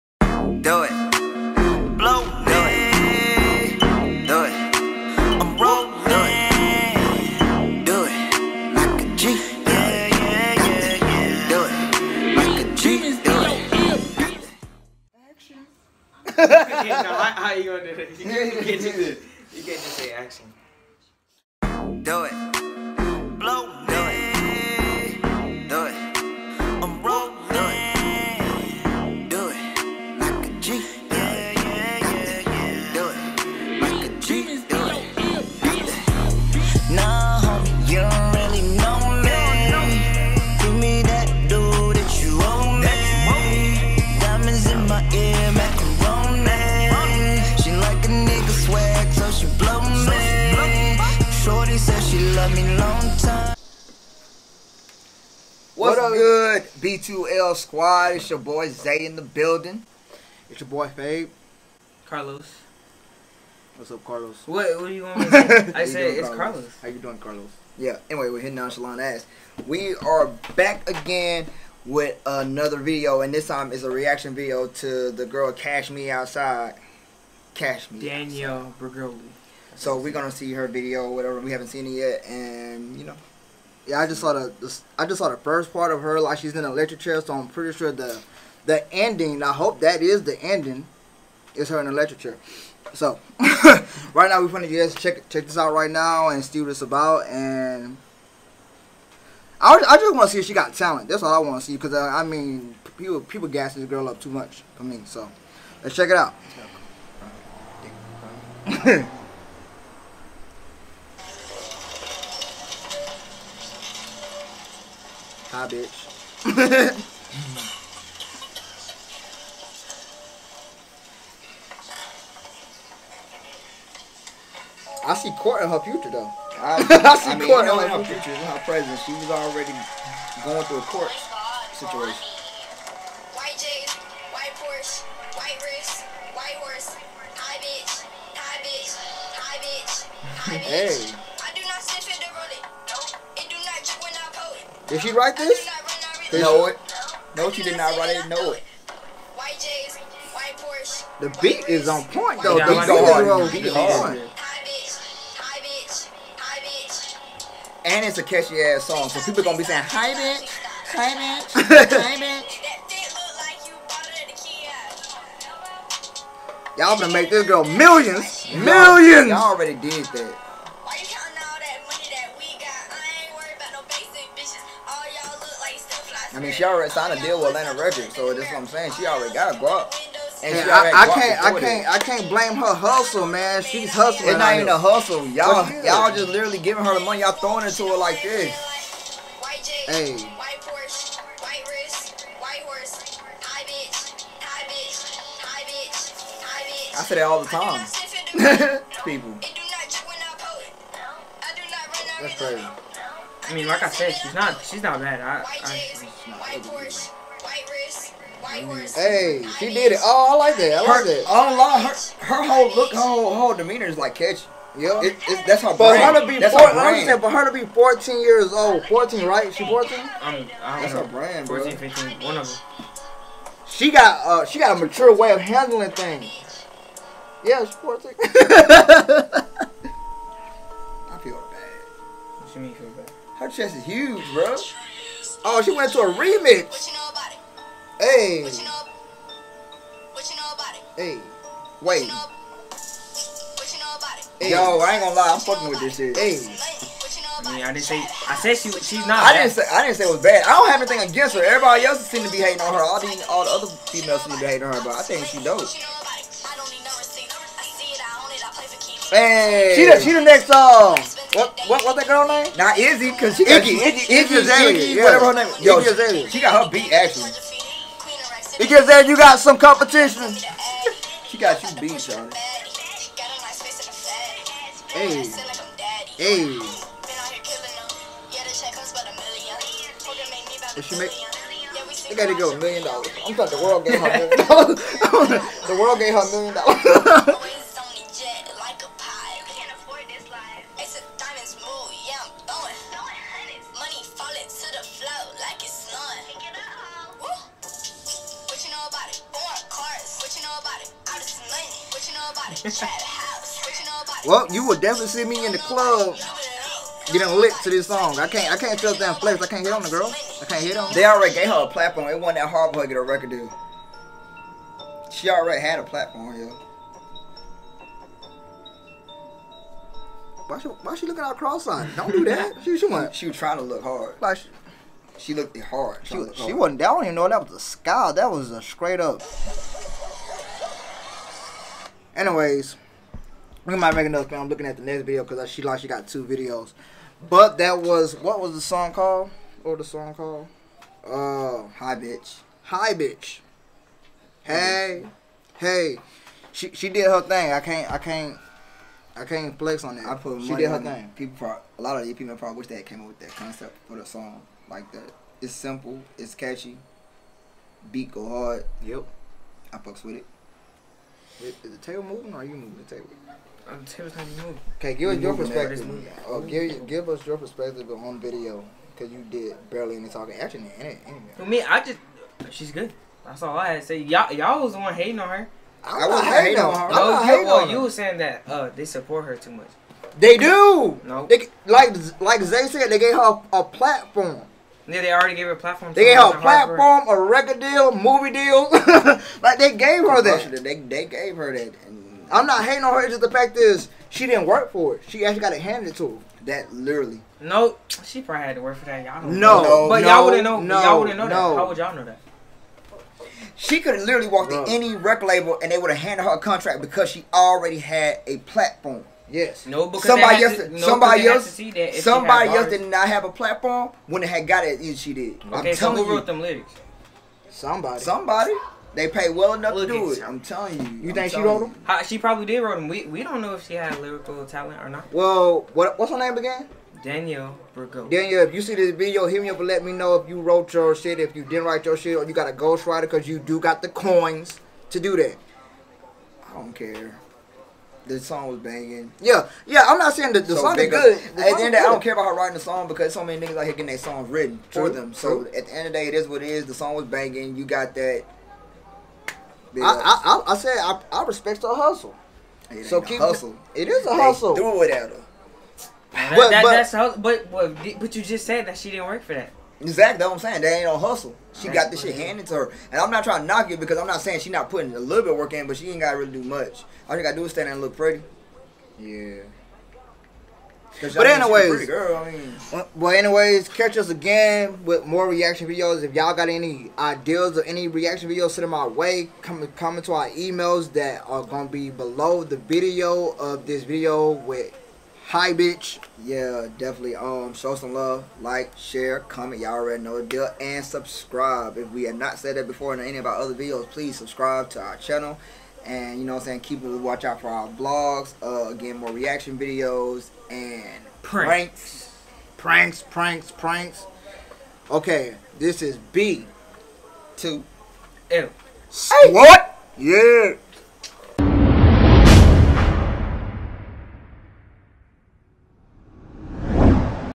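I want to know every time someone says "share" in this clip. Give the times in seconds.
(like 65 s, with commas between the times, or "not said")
488 s.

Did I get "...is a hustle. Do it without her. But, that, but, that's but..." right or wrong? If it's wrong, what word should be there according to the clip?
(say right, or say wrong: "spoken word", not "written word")
right.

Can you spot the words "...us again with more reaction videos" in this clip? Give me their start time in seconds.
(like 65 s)
473 s.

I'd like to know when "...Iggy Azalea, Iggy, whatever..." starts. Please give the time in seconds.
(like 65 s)
264 s.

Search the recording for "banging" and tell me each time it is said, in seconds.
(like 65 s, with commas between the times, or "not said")
438 s, 447 s.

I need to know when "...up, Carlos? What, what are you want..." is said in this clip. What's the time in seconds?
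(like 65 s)
63 s.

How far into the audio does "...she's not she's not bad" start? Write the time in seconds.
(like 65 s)
204 s.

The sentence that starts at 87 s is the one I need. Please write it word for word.
So I'm pretty sure the the ending.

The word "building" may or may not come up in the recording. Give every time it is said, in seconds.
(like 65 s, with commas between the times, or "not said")
59 s.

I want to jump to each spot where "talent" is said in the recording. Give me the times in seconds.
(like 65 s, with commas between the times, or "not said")
100 s, 424 s.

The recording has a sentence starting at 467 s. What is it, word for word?
All she got to do is stand there and look pretty.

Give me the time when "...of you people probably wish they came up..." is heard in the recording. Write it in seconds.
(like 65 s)
352 s.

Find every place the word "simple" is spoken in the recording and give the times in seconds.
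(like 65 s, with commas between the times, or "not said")
355 s.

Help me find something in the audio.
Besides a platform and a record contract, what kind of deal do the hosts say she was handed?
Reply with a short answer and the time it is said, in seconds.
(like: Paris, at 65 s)
Movie deal, at 387 s.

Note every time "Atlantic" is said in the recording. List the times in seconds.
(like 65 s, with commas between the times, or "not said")
177 s.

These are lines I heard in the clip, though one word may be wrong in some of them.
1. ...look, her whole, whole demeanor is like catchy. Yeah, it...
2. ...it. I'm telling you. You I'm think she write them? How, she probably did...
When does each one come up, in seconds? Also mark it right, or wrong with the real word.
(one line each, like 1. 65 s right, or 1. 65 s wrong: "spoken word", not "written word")
1. 212 s right
2. 420 s wrong: "wrote", not "write".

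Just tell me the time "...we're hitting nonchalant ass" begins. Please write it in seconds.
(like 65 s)
68 s.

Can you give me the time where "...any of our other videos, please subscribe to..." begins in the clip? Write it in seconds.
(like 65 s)
492 s.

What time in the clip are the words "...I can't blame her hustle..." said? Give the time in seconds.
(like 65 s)
181 s.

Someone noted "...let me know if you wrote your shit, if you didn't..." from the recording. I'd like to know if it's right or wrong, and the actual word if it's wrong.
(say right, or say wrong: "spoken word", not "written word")
right.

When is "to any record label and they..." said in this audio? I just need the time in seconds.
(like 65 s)
404 s.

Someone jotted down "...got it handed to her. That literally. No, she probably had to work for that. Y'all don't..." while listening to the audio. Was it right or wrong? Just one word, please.
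right.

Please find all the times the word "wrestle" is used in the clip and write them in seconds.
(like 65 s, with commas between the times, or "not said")
not said.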